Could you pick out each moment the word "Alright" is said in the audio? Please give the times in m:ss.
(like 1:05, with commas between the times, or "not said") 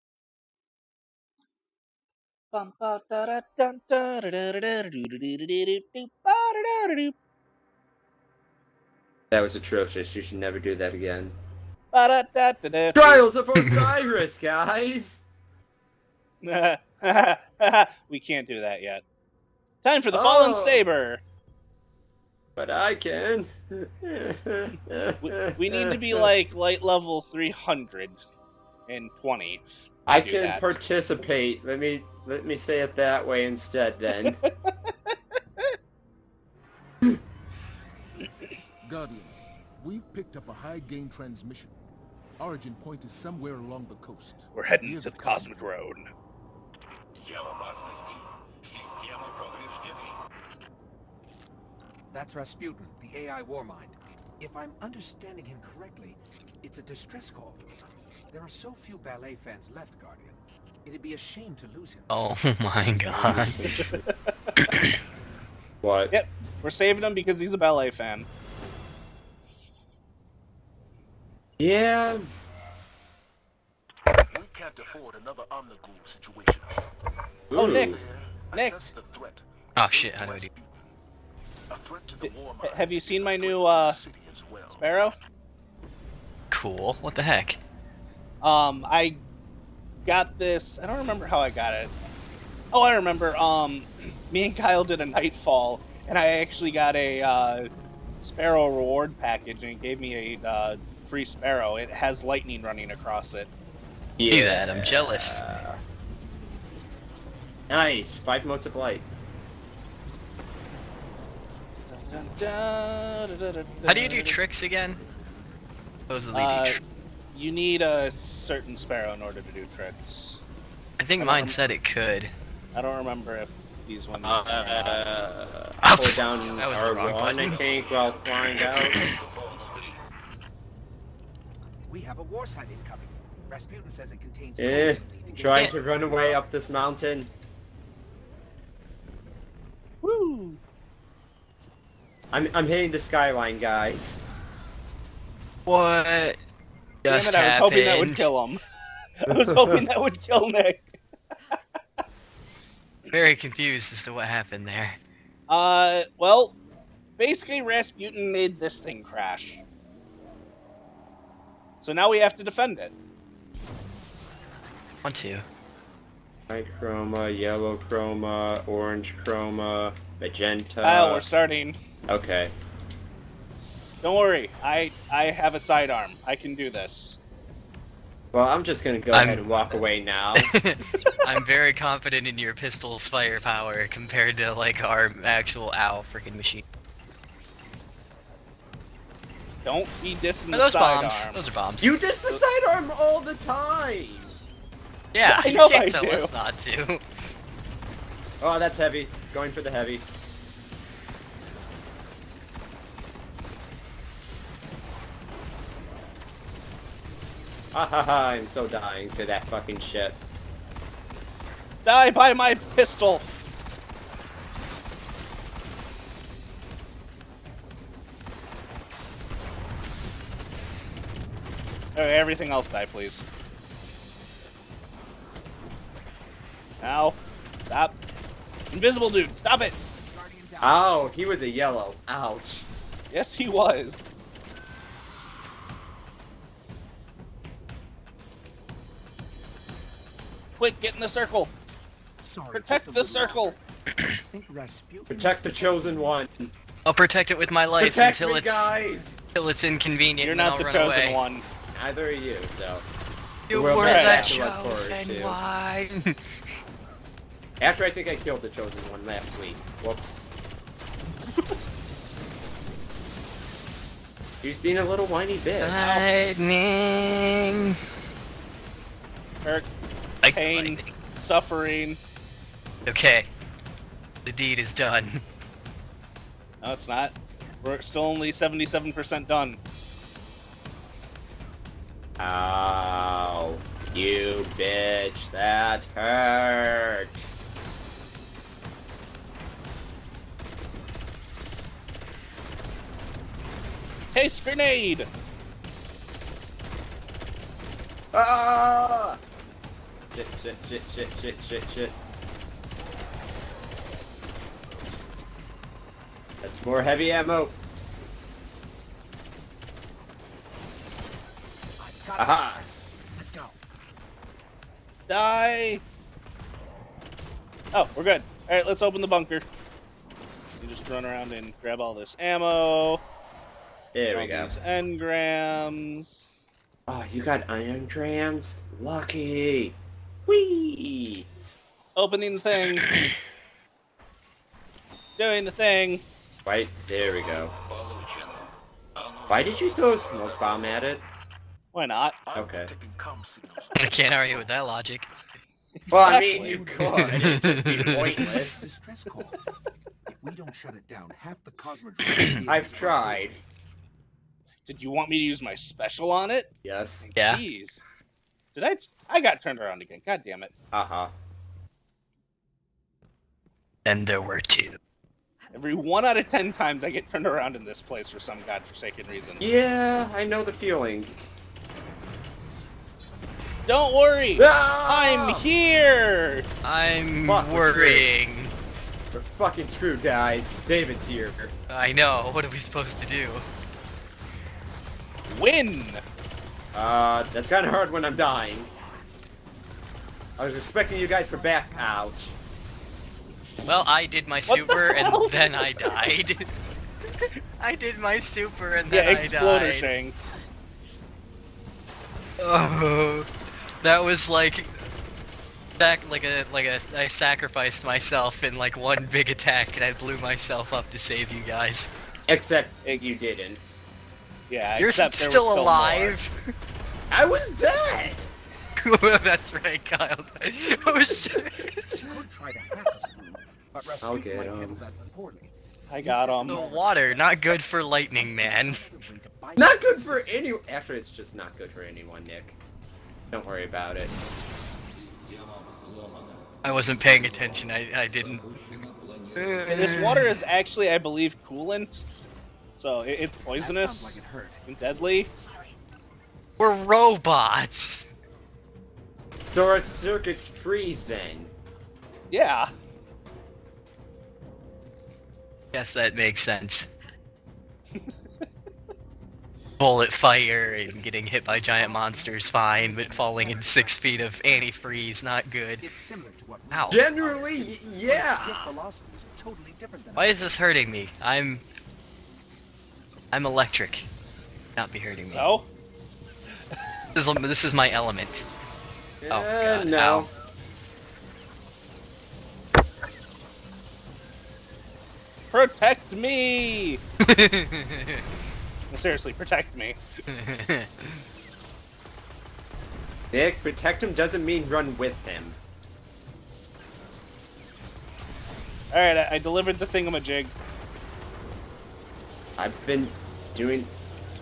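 5:18, 8:18.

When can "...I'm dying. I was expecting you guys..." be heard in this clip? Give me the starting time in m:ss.
6:28.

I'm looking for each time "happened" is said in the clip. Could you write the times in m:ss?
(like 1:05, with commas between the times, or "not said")
2:27, 2:34.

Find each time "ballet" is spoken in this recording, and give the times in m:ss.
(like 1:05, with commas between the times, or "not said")
0:58, 1:07.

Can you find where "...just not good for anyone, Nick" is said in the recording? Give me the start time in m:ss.
7:11.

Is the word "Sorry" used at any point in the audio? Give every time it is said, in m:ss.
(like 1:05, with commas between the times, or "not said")
4:02, 7:25.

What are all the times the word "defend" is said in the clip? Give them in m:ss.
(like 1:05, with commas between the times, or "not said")
2:42.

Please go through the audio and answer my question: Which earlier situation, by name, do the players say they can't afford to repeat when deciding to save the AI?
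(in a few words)
Omnigul.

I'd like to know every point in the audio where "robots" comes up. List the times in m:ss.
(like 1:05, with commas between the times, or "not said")
7:26.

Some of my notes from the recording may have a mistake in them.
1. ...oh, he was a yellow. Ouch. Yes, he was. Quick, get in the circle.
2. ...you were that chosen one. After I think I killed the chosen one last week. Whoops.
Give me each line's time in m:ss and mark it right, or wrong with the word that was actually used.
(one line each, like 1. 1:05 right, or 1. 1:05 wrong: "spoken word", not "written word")
1. 3:51 right
2. 4:13 right.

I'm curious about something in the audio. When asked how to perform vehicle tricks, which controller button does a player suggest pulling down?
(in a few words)
R1.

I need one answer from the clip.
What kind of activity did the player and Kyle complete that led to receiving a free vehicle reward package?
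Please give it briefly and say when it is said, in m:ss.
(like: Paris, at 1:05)
Nightfall, at 1:35.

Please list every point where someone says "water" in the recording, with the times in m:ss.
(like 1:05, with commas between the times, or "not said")
7:06, 7:19.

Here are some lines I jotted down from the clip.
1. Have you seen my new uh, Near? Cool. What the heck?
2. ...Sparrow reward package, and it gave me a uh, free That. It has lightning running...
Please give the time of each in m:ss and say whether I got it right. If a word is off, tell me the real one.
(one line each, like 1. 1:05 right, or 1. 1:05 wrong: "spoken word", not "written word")
1. 1:22 wrong: "Sparrow", not "Near"
2. 1:38 wrong: "Sparrow", not "That".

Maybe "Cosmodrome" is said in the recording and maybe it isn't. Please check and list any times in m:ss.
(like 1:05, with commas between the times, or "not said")
0:45, 5:51.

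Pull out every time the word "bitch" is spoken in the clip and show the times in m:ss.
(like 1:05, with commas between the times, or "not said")
4:25, 4:44.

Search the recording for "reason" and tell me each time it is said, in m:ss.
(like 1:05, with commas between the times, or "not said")
6:09.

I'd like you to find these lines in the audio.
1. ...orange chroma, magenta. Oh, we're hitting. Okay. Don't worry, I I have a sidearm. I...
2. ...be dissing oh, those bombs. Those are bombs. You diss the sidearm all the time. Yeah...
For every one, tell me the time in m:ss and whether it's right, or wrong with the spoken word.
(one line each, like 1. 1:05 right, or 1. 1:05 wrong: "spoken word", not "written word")
1. 2:48 wrong: "starting", not "hitting"
2. 3:10 right.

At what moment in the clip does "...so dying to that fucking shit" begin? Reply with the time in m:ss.
3:28.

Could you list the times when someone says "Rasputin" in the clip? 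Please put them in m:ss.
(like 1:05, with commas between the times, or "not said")
0:52, 2:13, 2:37.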